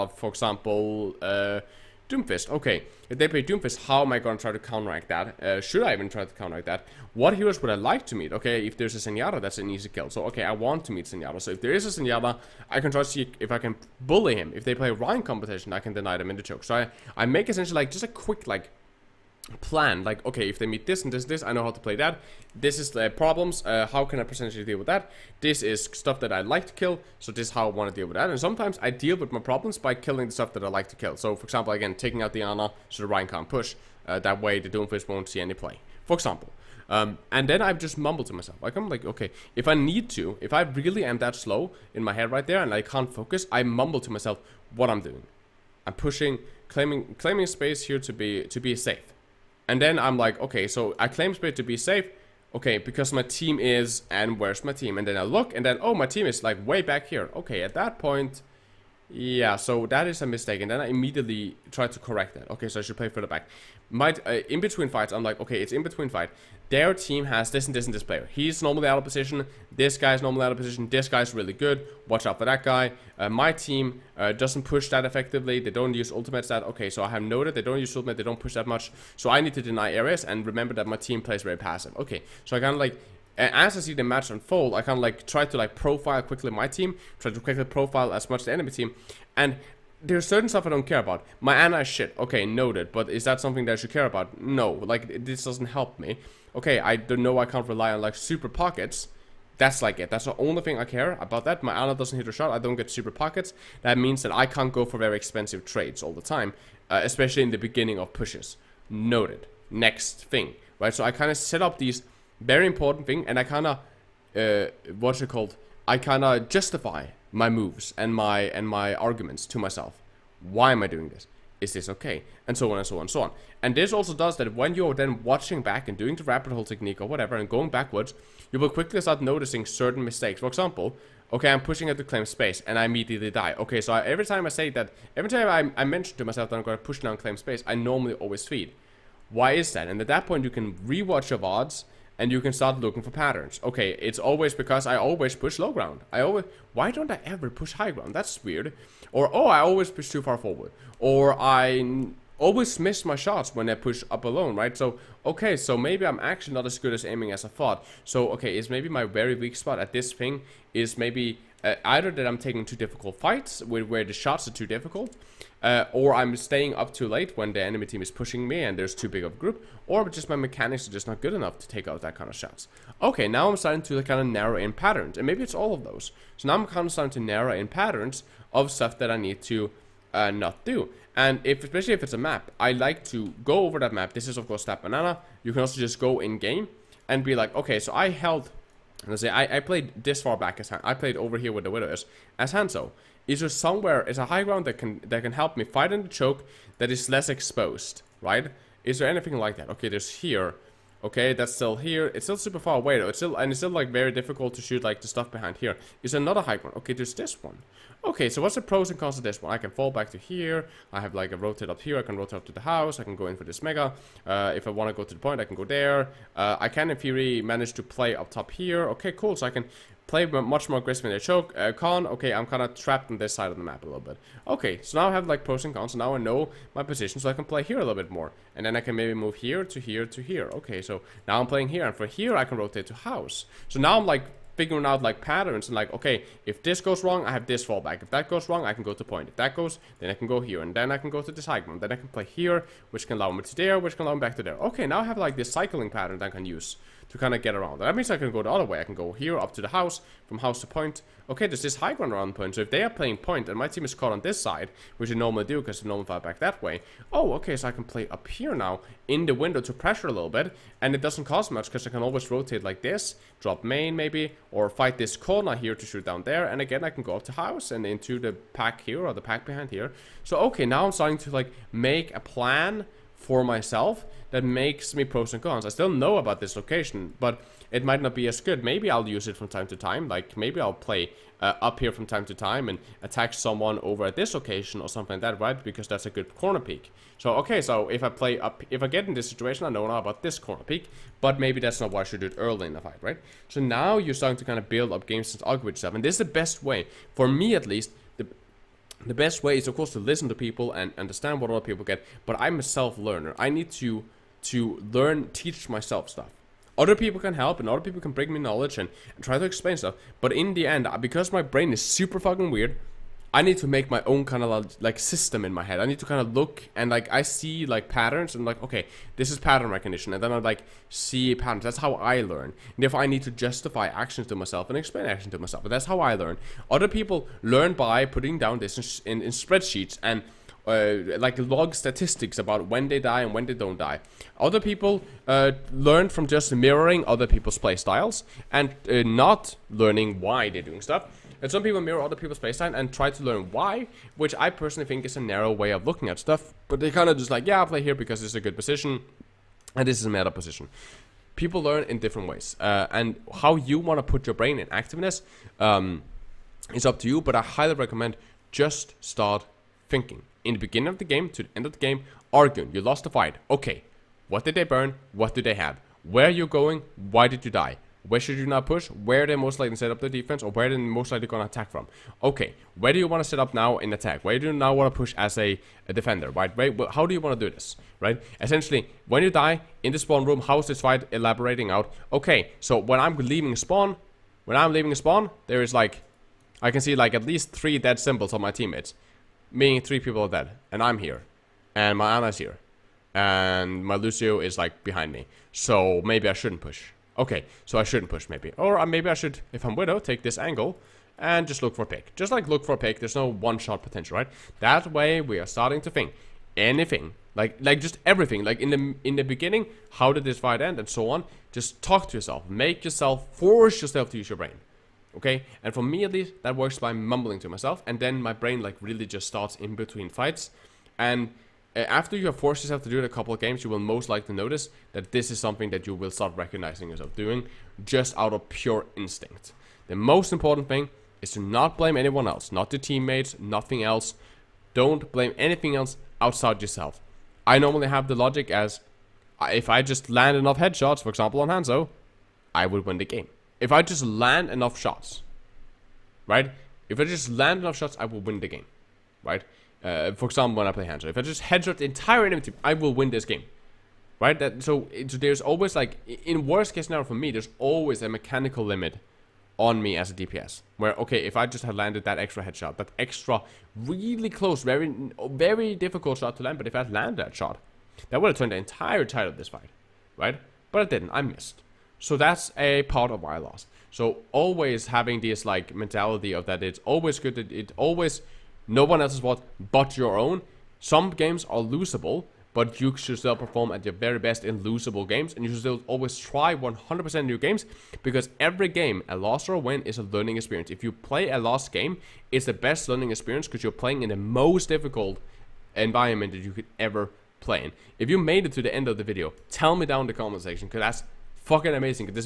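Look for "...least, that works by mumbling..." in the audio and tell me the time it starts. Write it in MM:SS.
06:56.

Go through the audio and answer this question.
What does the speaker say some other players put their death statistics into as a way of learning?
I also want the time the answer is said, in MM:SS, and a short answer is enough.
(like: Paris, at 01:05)
Spreadsheets, at 05:29.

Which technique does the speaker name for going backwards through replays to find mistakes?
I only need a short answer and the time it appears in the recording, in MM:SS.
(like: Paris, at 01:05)
Rabbit hole technique, at 02:06.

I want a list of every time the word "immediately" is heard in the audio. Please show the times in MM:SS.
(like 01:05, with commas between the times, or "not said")
01:00, 02:12.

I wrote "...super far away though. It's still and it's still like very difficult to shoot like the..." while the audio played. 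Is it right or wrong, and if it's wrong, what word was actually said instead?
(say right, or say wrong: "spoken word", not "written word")
right.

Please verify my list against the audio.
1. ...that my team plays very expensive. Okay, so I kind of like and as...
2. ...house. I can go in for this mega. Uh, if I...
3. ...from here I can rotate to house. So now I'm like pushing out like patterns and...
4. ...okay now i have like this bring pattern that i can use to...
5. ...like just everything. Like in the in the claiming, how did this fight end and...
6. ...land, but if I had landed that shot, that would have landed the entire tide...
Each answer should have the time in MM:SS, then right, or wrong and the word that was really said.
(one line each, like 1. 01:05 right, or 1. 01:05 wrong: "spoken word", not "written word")
1. 01:20 wrong: "passive", not "expensive"
2. 03:32 right
3. 03:51 wrong: "figuring", not "pushing"
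4. 04:04 wrong: "cycling", not "bring"
5. 06:47 wrong: "beginning", not "claiming"
6. 07:46 wrong: "turned", not "landed".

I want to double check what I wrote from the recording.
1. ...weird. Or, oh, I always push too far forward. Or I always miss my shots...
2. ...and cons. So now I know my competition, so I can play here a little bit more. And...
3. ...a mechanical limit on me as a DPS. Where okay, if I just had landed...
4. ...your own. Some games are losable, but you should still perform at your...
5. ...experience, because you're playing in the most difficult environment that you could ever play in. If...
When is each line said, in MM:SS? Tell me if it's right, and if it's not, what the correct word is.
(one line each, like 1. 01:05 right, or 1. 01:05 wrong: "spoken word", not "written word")
1. 02:28 right
2. 03:45 wrong: "position", not "competition"
3. 07:38 right
4. 07:59 right
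5. 08:13 right.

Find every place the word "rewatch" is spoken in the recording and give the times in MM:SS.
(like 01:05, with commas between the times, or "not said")
02:20.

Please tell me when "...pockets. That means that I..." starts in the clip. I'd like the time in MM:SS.
01:43.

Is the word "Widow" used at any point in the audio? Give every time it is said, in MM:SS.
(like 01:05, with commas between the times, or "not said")
03:11, 06:39.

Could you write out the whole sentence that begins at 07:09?
The most important thing is to not blame anyone else, not the teammates, nothing else.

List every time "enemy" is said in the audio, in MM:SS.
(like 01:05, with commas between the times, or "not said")
01:28, 02:47, 07:32.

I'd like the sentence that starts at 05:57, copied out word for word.
But I highly recommend just start thinking in the beginning of the game to the end of the game.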